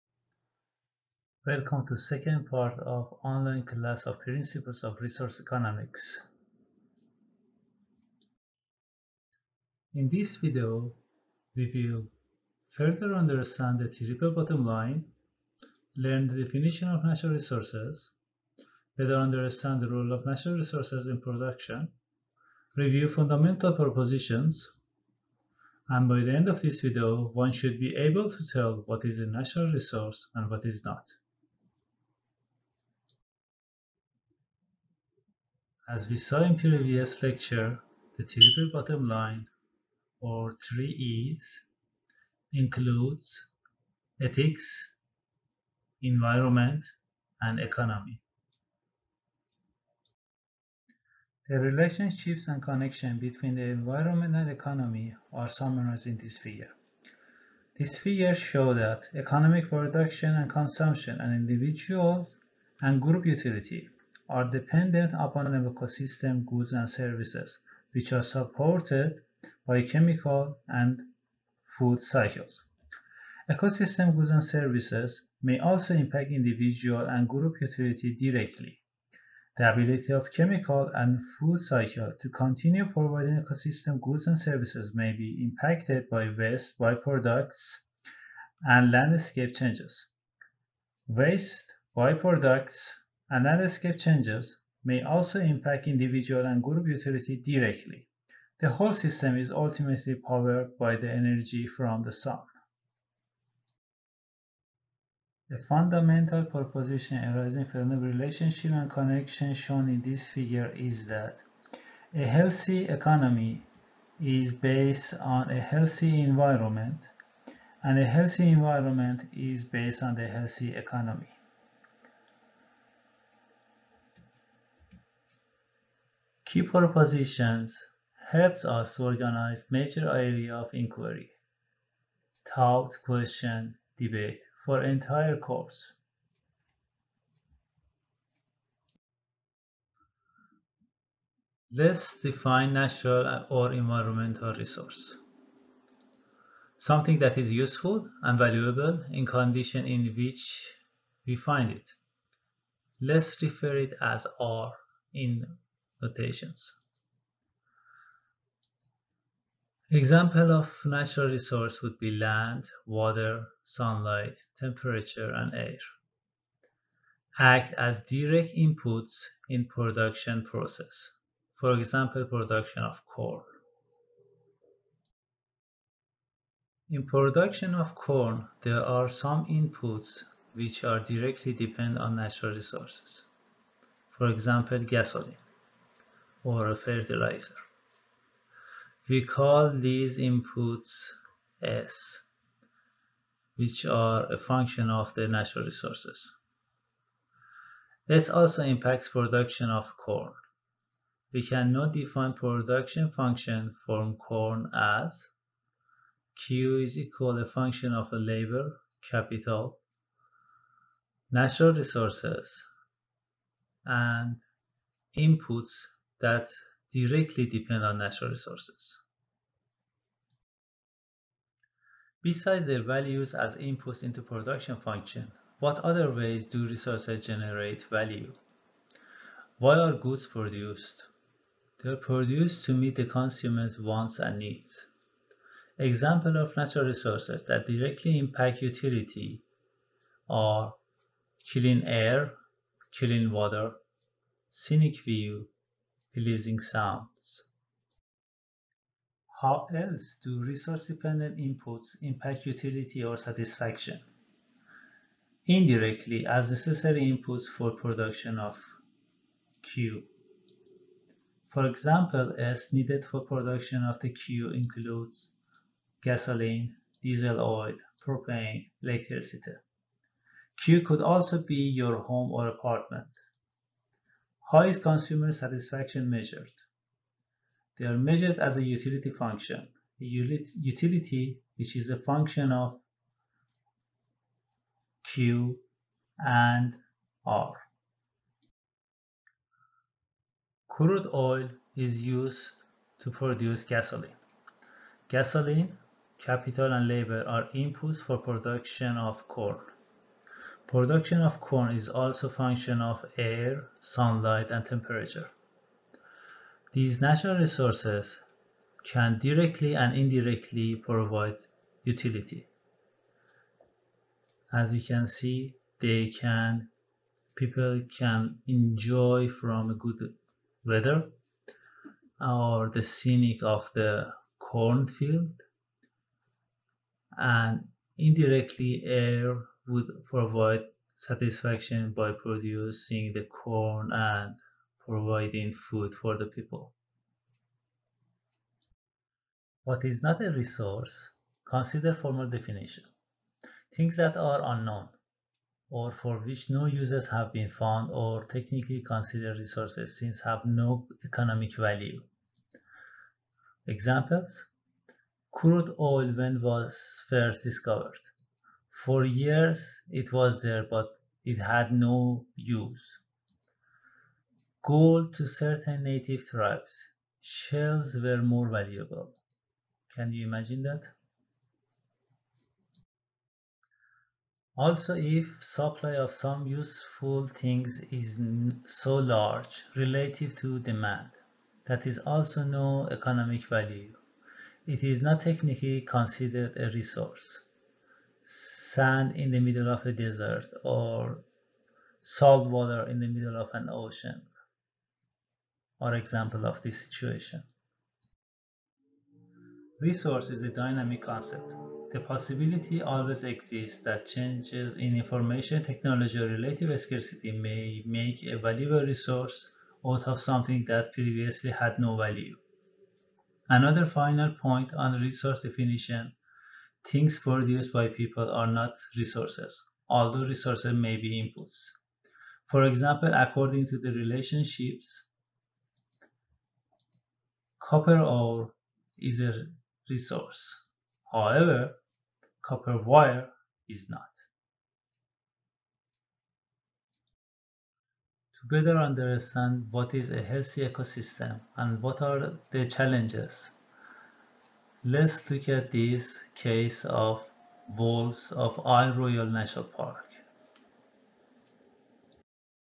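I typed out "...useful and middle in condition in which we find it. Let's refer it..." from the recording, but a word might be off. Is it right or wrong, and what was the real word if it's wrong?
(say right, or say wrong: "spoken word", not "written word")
wrong: "valuable", not "middle".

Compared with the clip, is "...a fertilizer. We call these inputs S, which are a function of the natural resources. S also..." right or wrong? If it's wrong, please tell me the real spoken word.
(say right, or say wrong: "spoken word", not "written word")
right.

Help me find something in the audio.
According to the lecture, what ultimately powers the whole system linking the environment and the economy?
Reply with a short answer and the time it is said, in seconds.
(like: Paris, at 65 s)
energy from the sun, at 101 s.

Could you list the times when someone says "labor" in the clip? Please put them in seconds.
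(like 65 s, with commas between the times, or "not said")
208 s, 296 s.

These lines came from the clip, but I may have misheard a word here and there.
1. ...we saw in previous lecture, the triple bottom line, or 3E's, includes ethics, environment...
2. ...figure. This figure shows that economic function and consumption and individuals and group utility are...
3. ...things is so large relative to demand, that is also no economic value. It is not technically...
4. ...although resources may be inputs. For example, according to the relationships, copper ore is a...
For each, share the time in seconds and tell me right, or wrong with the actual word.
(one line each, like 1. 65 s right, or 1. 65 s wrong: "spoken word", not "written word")
1. 36 s right
2. 56 s wrong: "production", not "function"
3. 377 s right
4. 419 s right.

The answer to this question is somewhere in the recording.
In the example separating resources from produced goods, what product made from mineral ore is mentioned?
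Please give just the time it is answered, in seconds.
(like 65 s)
432 s.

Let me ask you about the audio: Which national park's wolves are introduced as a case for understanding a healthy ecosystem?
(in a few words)
Isle Royale National Park.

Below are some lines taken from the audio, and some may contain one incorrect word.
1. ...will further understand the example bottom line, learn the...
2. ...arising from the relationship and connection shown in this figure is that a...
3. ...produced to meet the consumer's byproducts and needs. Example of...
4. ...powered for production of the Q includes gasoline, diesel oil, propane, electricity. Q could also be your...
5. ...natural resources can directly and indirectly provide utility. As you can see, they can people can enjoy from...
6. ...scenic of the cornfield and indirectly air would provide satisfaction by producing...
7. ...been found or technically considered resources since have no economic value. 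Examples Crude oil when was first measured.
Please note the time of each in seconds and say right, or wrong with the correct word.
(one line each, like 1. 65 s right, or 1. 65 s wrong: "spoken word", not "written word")
1. 11 s wrong: "triple", not "example"
2. 107 s right
3. 231 s wrong: "wants", not "byproducts"
4. 262 s wrong: "needed", not "powered"
5. 307 s right
6. 322 s right
7. 347 s wrong: "discovered", not "measured".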